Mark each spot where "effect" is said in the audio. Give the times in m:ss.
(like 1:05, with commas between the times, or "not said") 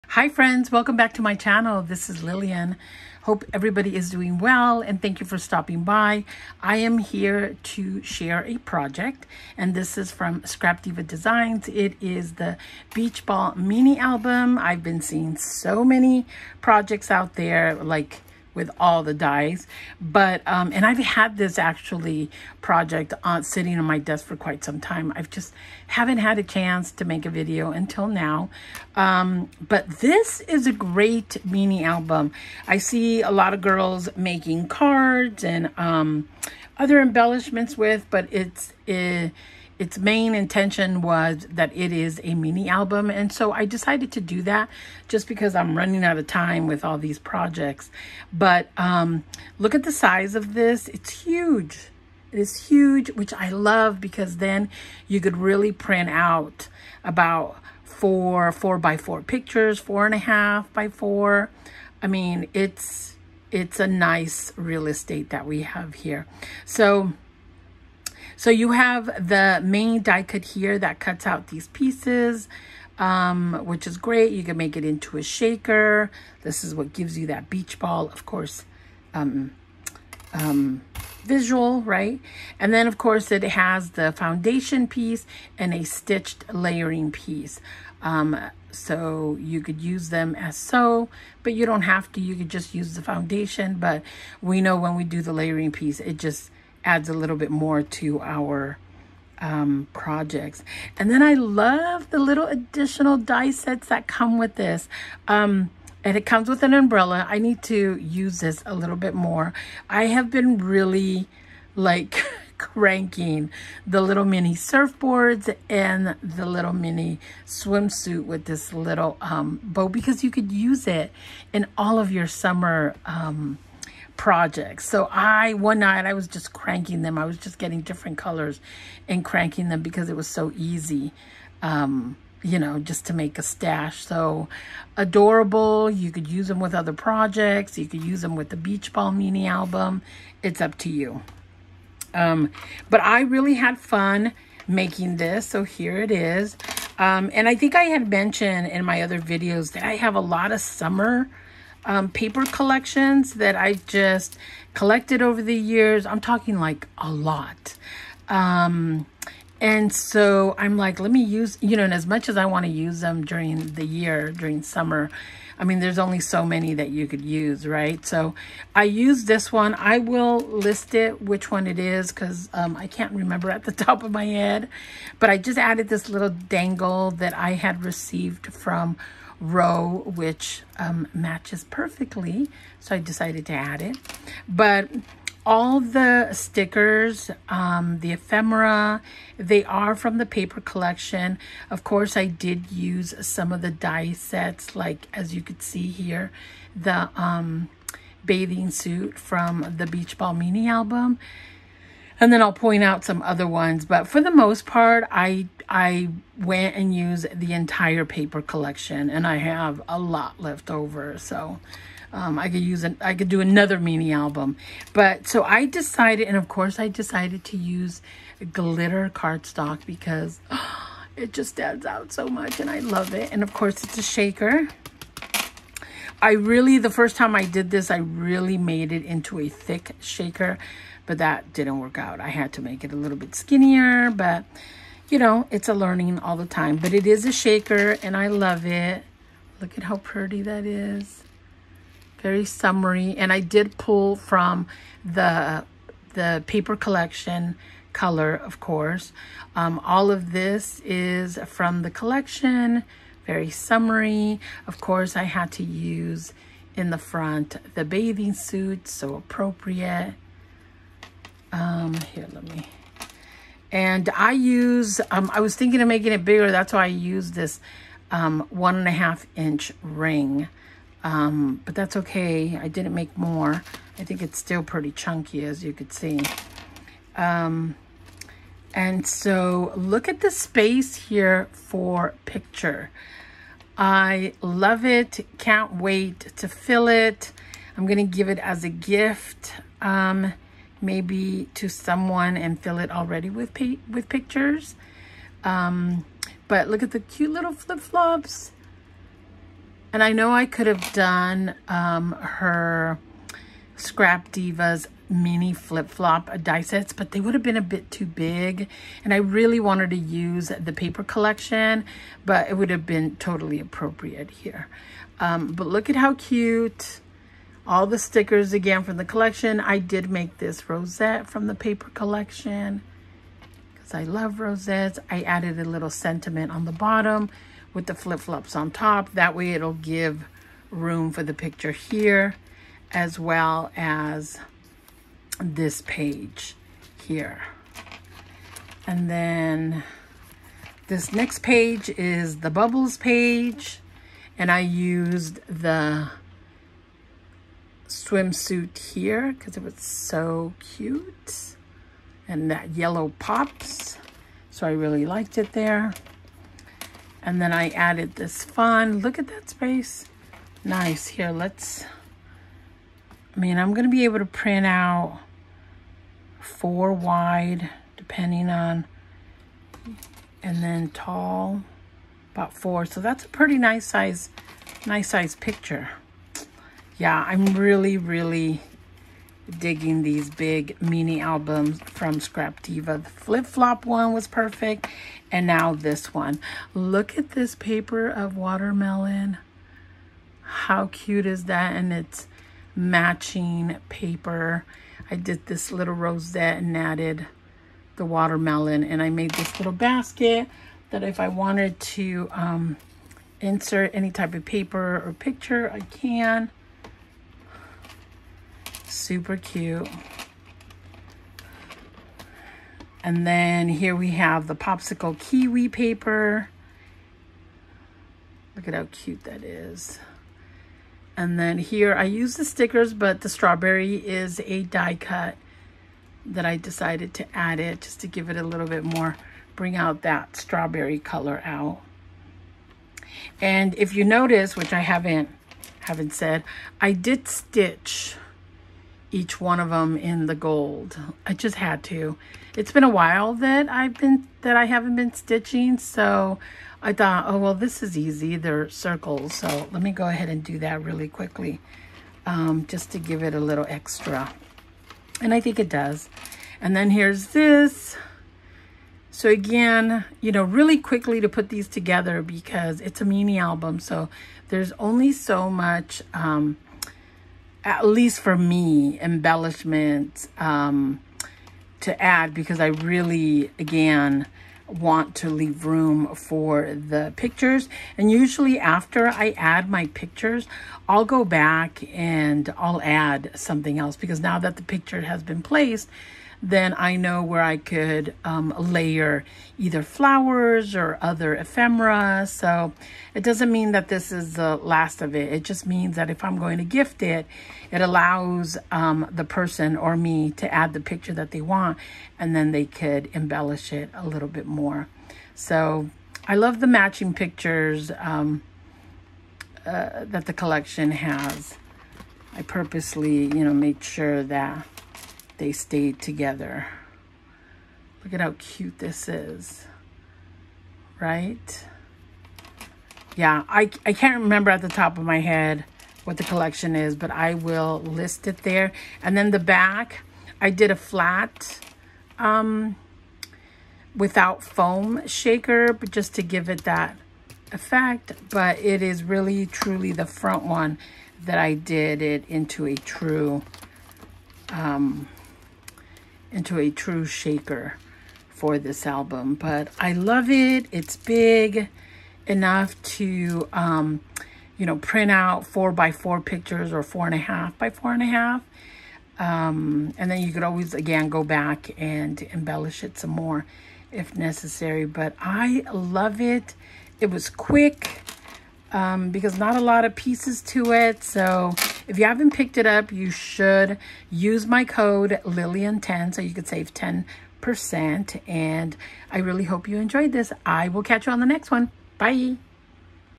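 8:57.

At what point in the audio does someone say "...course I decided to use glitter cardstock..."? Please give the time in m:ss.
3:36.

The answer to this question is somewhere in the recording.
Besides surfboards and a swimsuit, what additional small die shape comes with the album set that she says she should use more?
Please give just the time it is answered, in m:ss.
1:46.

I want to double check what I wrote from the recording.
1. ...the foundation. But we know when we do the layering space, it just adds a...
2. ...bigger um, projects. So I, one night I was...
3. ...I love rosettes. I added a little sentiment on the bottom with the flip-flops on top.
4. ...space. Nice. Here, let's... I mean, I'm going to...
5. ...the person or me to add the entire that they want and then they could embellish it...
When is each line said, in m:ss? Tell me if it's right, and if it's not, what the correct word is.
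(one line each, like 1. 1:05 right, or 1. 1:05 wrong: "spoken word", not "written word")
1. 1:32 wrong: "piece", not "space"
2. 2:02 wrong: "summer", not "bigger"
3. 5:23 right
4. 5:59 right
5. 8:19 wrong: "picture", not "entire".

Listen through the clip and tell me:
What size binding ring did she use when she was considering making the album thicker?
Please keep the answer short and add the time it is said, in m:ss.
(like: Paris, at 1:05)
1.5 inch, at 4:28.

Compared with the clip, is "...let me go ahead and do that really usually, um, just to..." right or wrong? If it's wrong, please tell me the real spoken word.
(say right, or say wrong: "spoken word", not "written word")
wrong: "quickly", not "usually".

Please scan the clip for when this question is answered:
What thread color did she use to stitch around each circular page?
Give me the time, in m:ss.
7:20.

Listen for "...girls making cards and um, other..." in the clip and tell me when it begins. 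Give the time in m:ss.
0:33.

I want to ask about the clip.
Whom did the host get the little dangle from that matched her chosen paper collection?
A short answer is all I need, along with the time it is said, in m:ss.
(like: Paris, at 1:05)
Row, at 2:59.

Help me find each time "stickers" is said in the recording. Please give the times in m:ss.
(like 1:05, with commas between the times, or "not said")
3:06, 5:17, 7:02.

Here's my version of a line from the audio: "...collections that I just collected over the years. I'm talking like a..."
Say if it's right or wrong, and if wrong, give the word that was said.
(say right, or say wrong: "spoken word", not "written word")
right.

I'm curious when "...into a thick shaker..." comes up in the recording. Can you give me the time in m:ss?
3:49.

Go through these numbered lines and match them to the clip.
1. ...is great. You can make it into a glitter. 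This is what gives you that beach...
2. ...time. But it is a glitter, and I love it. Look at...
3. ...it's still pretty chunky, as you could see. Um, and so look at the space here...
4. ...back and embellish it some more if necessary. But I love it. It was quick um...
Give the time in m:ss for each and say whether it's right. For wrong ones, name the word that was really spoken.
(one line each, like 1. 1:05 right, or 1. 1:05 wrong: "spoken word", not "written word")
1. 1:13 wrong: "shaker", not "glitter"
2. 3:56 wrong: "shaker", not "glitter"
3. 4:34 right
4. 9:21 right.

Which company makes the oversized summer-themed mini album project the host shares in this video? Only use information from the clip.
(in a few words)
Scrap Diva Designs.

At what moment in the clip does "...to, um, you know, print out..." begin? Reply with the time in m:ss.
9:12.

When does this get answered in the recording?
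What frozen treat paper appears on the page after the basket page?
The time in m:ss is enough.
6:54.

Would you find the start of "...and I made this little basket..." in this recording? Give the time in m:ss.
6:38.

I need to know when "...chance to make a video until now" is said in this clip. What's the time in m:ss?
0:26.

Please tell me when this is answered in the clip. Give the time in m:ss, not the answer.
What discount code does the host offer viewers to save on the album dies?
9:35.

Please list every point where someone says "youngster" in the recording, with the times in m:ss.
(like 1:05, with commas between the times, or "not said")
not said.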